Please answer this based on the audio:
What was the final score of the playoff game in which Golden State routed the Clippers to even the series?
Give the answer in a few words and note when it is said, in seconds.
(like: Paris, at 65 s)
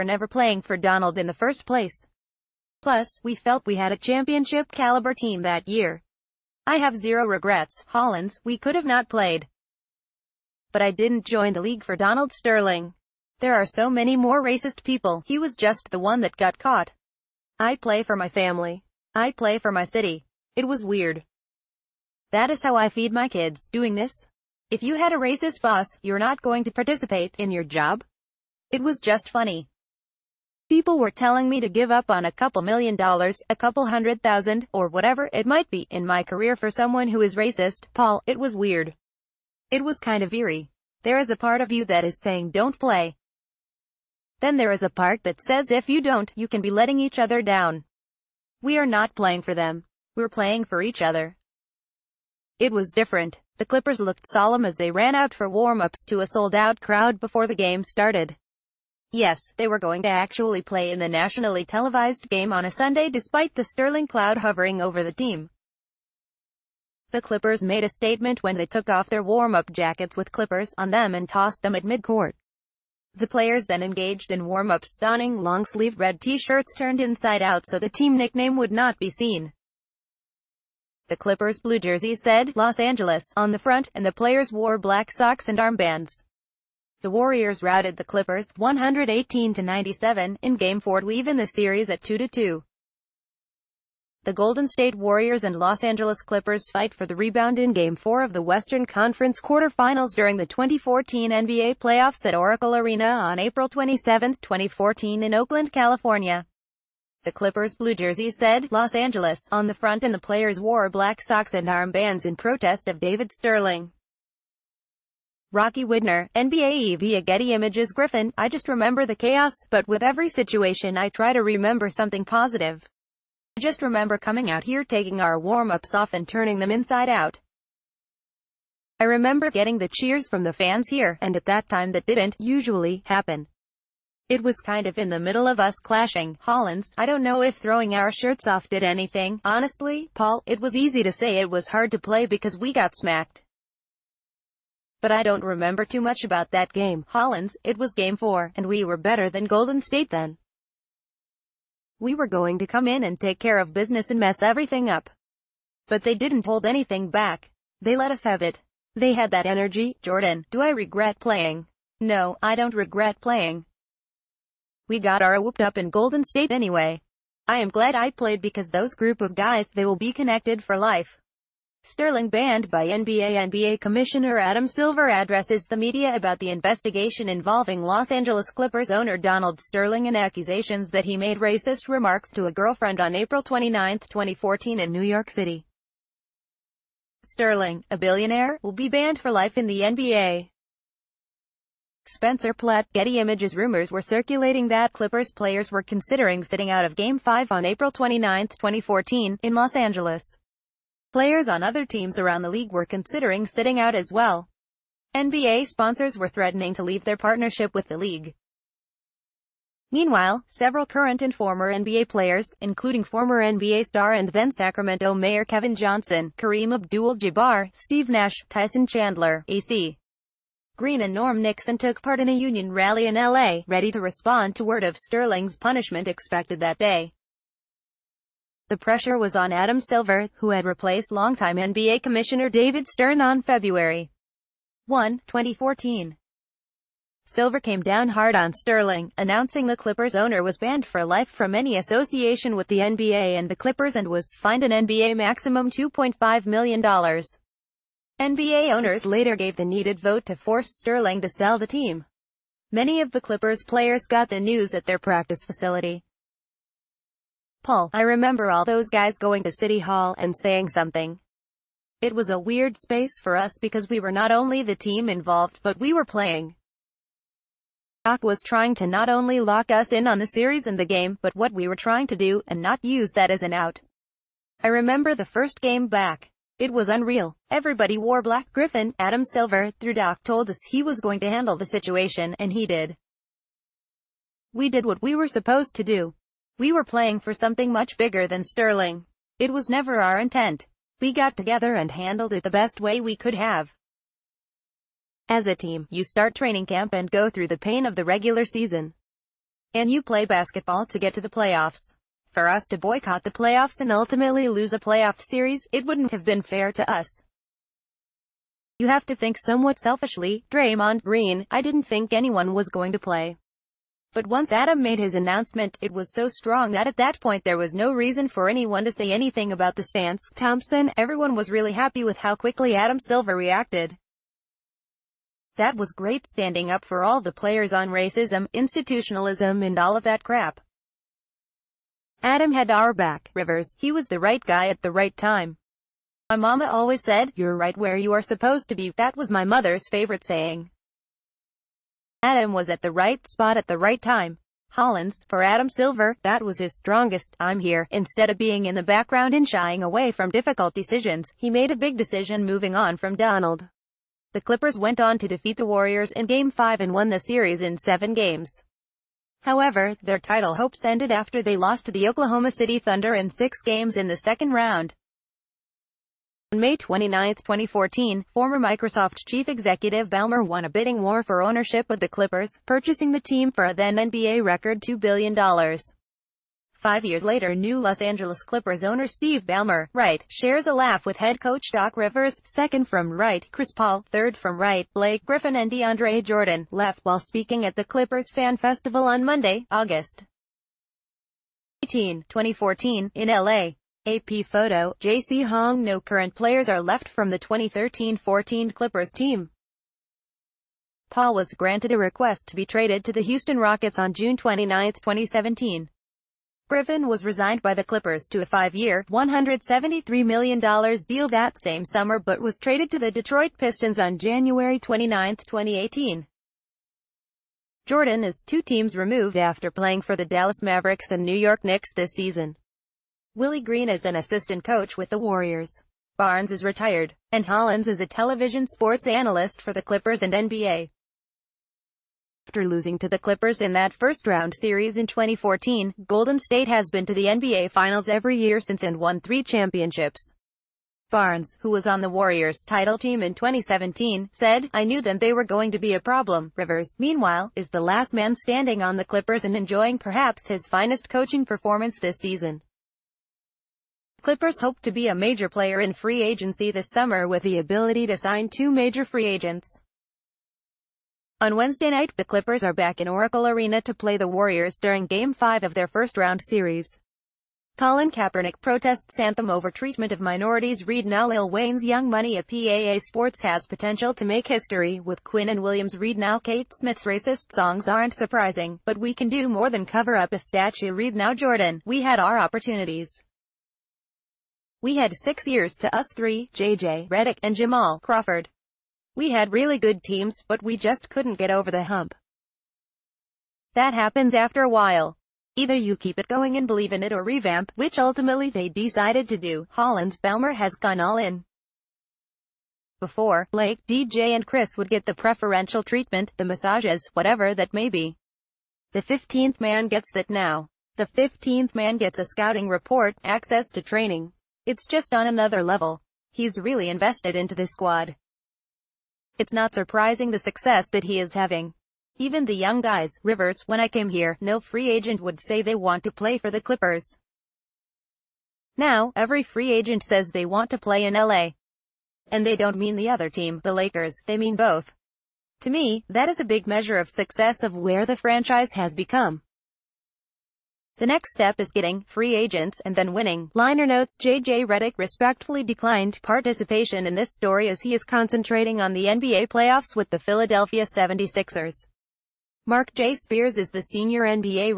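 118-97, at 88 s.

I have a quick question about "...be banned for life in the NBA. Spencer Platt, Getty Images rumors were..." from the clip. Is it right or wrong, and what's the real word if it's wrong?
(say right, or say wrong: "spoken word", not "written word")
right.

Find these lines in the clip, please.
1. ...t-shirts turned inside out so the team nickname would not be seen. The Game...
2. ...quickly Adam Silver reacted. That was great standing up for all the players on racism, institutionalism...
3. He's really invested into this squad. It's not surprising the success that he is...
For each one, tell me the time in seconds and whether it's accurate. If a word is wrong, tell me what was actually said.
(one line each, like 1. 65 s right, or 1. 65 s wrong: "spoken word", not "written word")
1. 76 s wrong: "Clippers", not "Game"
2. 322 s right
3. 516 s right.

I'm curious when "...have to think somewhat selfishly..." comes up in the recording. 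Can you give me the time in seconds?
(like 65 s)
308 s.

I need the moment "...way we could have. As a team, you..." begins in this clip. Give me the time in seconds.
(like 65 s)
292 s.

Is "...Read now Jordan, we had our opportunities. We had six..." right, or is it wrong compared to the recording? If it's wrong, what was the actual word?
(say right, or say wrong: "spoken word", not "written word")
right.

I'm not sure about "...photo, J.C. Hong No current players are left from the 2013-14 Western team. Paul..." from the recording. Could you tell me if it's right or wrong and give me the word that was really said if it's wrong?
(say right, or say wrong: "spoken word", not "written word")
wrong: "Clippers", not "Western".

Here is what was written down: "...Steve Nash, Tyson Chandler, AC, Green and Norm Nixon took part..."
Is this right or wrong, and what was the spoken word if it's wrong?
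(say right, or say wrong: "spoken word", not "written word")
right.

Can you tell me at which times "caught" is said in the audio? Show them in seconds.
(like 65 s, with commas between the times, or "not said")
16 s.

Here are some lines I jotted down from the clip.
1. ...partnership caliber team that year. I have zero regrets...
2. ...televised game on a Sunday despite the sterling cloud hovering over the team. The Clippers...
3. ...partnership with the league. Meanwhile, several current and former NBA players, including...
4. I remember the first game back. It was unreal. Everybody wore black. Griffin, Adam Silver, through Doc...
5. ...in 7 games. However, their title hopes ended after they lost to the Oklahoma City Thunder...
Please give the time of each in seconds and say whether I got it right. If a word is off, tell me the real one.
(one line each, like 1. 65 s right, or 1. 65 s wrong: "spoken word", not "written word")
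1. 3 s wrong: "championship", not "partnership"
2. 61 s right
3. 207 s right
4. 274 s right
5. 357 s right.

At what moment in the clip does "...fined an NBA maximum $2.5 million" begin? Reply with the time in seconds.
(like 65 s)
244 s.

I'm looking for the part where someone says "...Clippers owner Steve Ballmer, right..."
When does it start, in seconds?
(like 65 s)
378 s.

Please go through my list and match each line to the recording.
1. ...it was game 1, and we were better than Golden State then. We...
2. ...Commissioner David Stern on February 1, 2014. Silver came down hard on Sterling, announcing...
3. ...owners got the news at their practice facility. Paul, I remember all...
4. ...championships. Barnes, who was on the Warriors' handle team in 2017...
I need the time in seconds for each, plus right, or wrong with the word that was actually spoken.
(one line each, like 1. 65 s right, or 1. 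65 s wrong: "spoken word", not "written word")
1. 147 s wrong: "4", not "1"
2. 232 s right
3. 253 s wrong: "players", not "owners"
4. 439 s wrong: "title", not "handle".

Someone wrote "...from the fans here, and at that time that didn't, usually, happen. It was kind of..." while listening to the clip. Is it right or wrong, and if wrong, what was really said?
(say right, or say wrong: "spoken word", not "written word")
right.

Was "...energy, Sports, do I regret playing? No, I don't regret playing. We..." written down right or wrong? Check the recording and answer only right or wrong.
wrong.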